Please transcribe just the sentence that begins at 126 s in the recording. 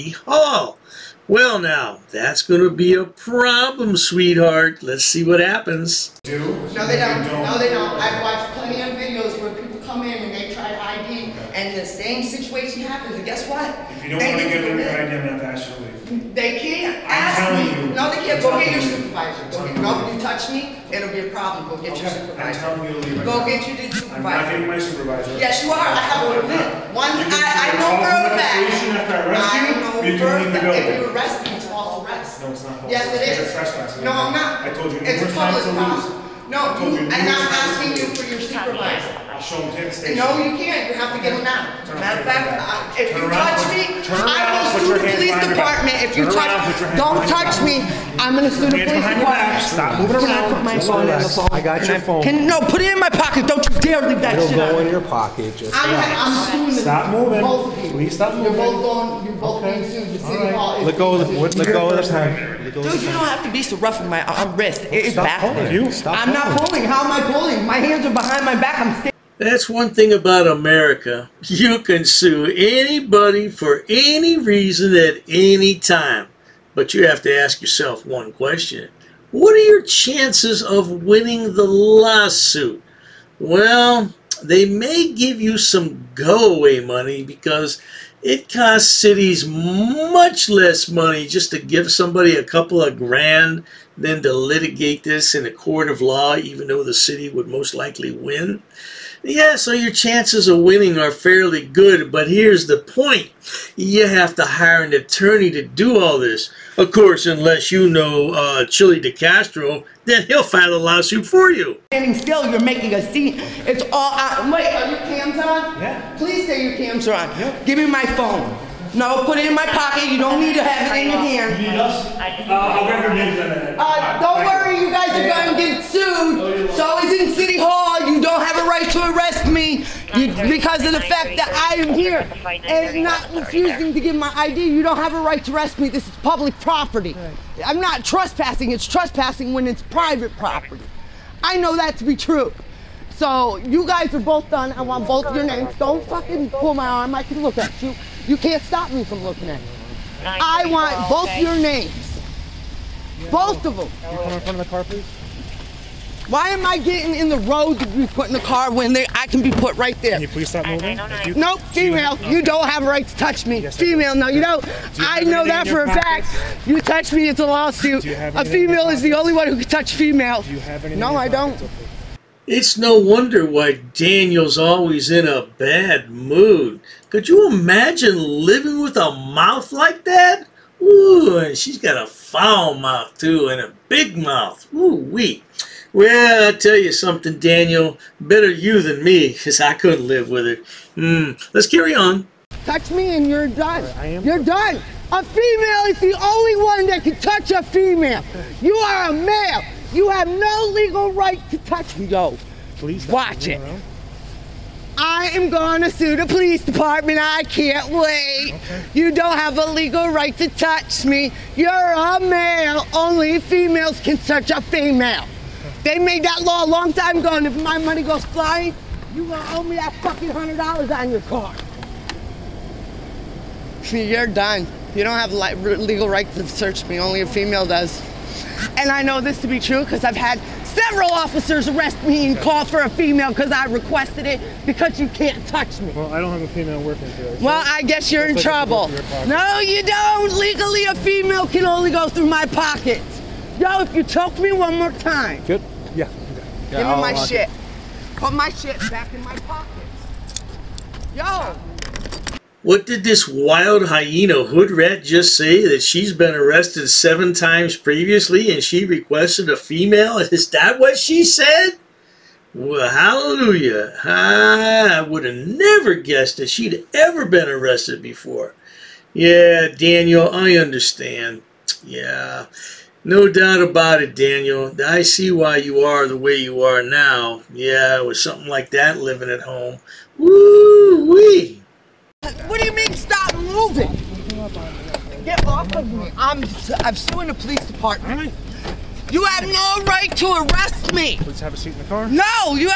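Oh, it's always in City Hall.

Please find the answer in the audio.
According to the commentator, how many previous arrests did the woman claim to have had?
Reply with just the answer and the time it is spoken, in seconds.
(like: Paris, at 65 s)
7, at 256 s.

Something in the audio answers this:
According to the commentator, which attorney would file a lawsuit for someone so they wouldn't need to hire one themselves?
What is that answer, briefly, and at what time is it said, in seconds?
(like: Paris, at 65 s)
Chille DeCastro, at 108 s.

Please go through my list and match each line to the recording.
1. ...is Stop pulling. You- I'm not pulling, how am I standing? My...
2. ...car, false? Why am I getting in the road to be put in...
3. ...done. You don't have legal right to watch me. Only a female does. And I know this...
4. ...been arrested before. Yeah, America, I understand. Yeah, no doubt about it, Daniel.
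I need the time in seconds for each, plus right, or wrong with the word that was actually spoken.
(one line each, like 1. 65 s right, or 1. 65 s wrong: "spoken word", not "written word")
1. 65 s wrong: "pulling", not "standing"
2. 154 s wrong: "please", not "false"
3. 224 s wrong: "search", not "watch"
4. 267 s wrong: "Daniel", not "America".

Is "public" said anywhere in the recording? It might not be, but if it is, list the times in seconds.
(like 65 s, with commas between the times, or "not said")
35 s, 136 s.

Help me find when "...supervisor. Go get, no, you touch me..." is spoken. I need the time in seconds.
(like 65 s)
18 s.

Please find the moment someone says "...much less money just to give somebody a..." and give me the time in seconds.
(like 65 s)
89 s.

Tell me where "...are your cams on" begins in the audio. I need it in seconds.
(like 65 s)
114 s.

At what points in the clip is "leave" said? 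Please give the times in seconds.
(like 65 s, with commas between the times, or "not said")
15 s, 23 s, 54 s.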